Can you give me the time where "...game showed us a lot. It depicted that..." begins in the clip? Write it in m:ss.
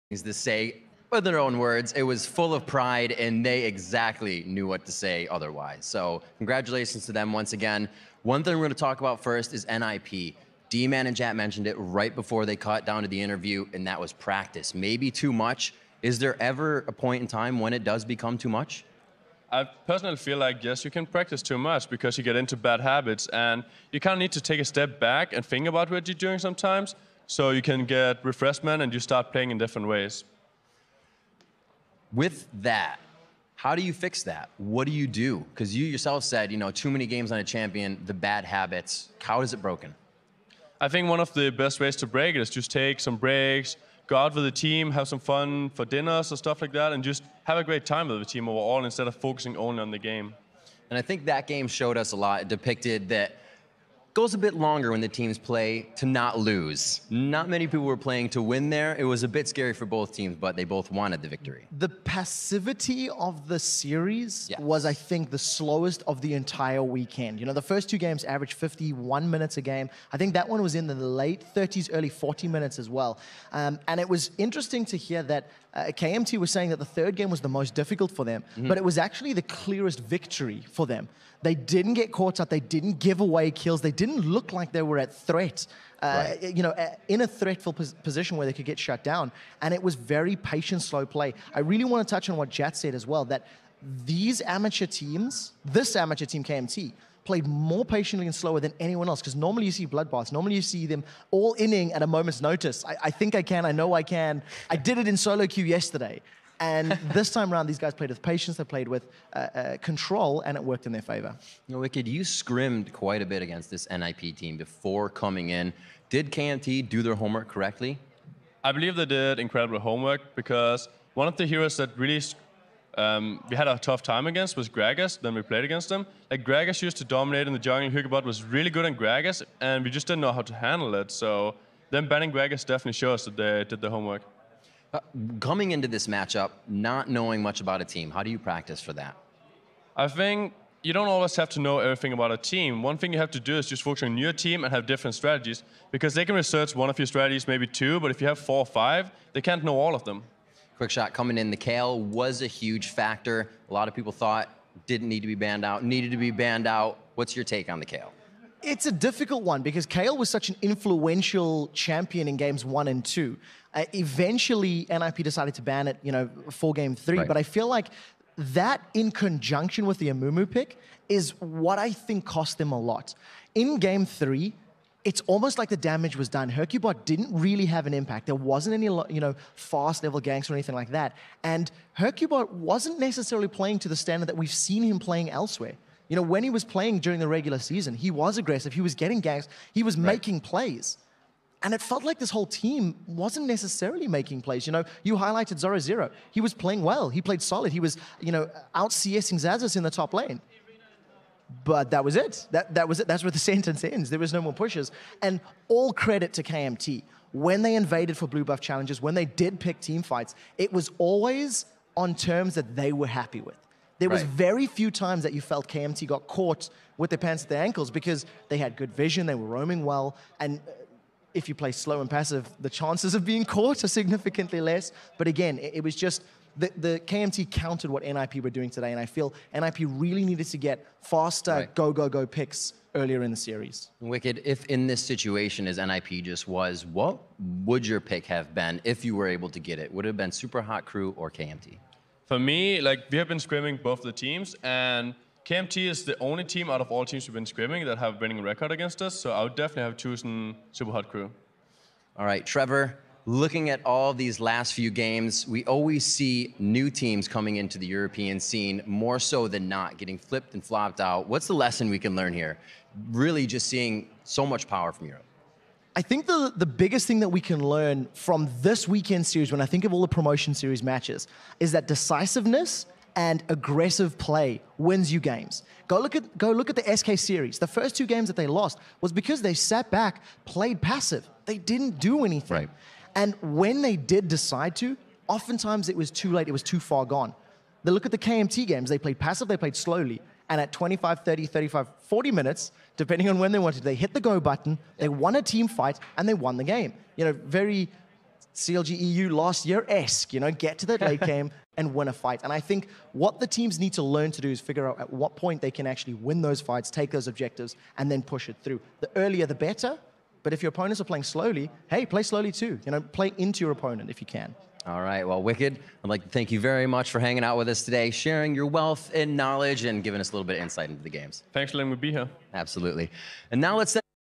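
0:51.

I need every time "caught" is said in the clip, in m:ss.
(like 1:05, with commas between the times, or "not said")
0:12, 1:22, 3:36, 3:43.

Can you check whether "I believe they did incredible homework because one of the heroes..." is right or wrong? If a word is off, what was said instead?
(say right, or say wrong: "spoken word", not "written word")
right.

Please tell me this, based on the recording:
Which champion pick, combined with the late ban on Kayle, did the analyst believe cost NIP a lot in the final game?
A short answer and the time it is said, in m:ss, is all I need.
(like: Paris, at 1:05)
Amumu, at 2:50.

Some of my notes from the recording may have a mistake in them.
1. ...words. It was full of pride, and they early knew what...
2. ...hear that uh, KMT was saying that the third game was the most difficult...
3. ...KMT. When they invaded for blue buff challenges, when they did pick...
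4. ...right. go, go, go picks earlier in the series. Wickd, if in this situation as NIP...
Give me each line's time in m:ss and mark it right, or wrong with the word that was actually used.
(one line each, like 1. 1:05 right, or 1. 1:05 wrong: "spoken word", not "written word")
1. 0:01 wrong: "exactly", not "early"
2. 1:14 right
3. 3:26 right
4. 3:51 right.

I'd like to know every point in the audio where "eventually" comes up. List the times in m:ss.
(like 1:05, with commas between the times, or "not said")
2:43.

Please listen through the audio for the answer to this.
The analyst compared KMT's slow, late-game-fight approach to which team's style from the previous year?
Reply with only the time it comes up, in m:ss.
4:58.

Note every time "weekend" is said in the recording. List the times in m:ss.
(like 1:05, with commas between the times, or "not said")
1:06, 4:28.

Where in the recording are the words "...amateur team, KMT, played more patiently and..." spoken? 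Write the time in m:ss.
1:35.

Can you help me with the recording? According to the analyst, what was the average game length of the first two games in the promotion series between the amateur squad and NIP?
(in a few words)
51 minutes.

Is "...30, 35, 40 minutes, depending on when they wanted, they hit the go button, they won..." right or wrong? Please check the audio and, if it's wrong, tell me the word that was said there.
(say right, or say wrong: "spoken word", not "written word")
right.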